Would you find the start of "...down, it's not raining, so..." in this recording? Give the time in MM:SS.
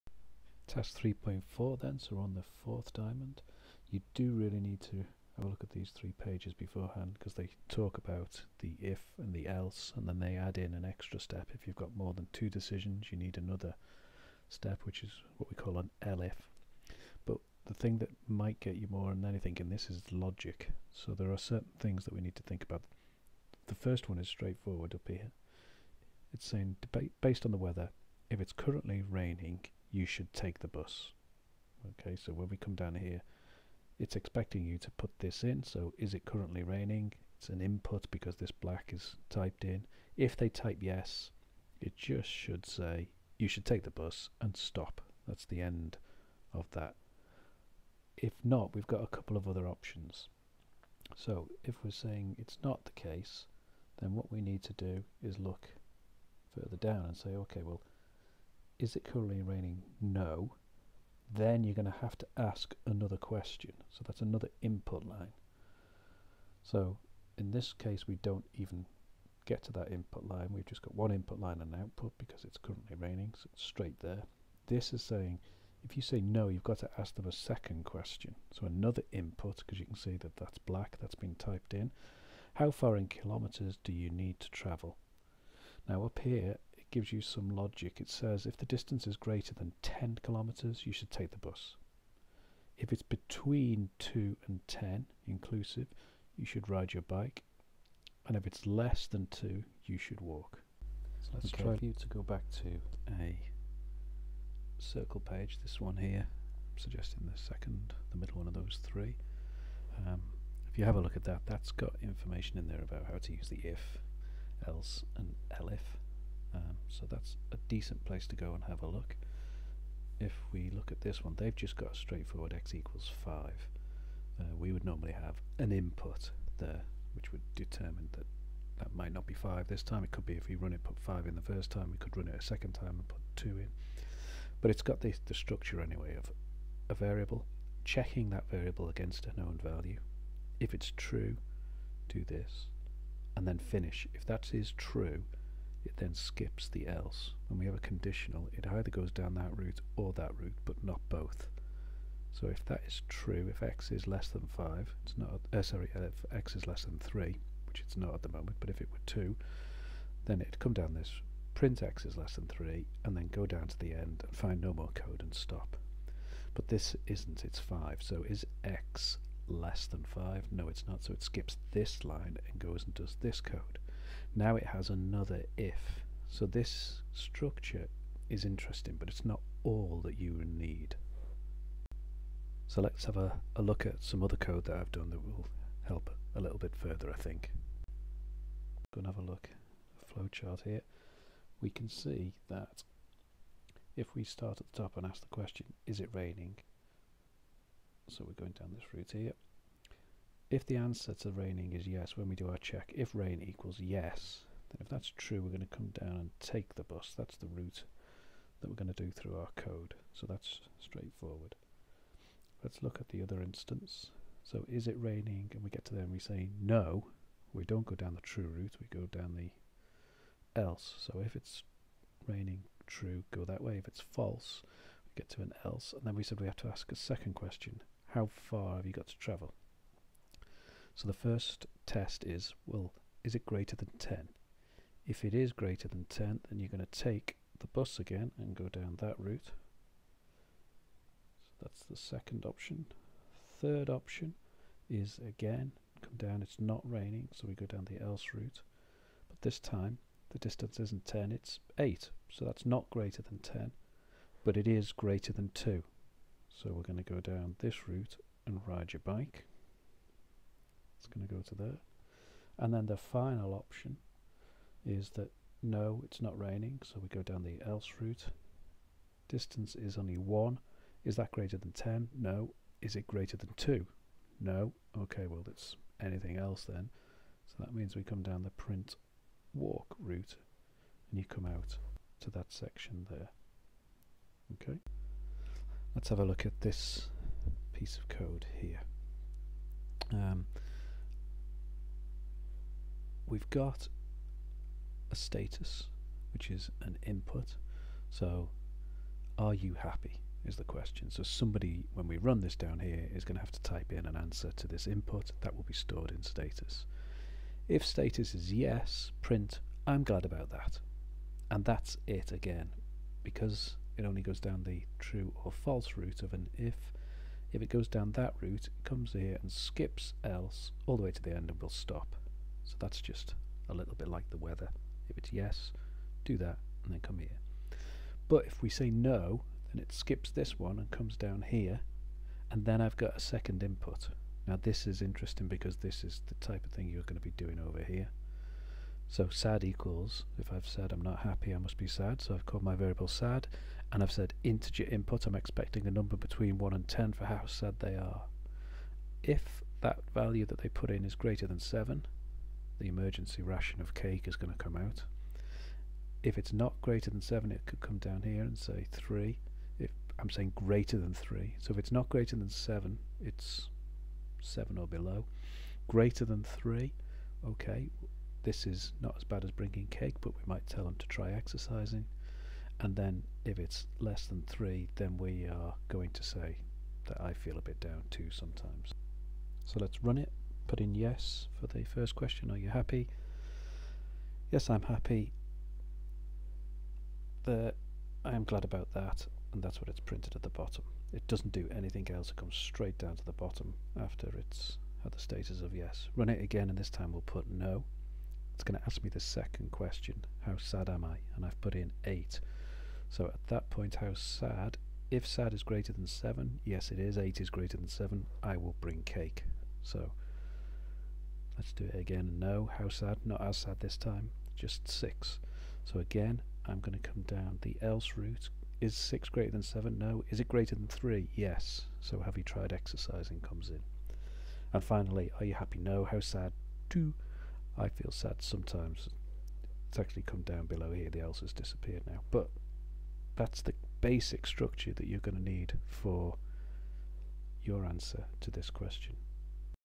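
04:06.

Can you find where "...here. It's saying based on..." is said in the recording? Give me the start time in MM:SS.
00:25.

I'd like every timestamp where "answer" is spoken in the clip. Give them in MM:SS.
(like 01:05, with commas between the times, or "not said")
03:20, 05:04, 07:17.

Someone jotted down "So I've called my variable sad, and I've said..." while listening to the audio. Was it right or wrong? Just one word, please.
right.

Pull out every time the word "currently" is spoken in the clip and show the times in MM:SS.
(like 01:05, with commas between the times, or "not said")
00:28, 00:36, 00:59, 01:12.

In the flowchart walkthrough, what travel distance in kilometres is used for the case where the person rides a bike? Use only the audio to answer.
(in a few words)
8.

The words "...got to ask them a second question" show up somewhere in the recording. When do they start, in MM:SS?
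01:16.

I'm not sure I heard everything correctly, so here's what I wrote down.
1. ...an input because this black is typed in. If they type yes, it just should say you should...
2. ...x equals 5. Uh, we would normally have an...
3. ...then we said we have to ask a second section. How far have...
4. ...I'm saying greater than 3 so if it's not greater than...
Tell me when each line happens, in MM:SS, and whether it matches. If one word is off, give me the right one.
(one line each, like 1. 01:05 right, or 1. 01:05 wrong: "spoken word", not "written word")
1. 00:37 right
2. 02:02 right
3. 03:46 wrong: "question", not "section"
4. 06:00 right.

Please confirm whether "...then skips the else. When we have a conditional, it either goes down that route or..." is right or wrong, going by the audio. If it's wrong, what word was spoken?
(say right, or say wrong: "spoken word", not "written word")
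right.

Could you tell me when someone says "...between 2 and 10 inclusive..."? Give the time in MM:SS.
01:33.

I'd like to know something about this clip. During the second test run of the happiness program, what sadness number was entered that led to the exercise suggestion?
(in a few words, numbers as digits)
6.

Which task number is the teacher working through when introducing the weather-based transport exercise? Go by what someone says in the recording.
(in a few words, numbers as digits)
3.4.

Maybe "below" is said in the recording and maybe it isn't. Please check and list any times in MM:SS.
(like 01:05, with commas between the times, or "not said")
06:04, 07:10.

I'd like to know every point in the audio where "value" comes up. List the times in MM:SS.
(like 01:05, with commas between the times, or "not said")
02:19, 05:50.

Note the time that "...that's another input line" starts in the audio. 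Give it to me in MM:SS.
01:04.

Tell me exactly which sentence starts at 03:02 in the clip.
So let's have a, a look at some other code that I've done that will help a little bit further, I think.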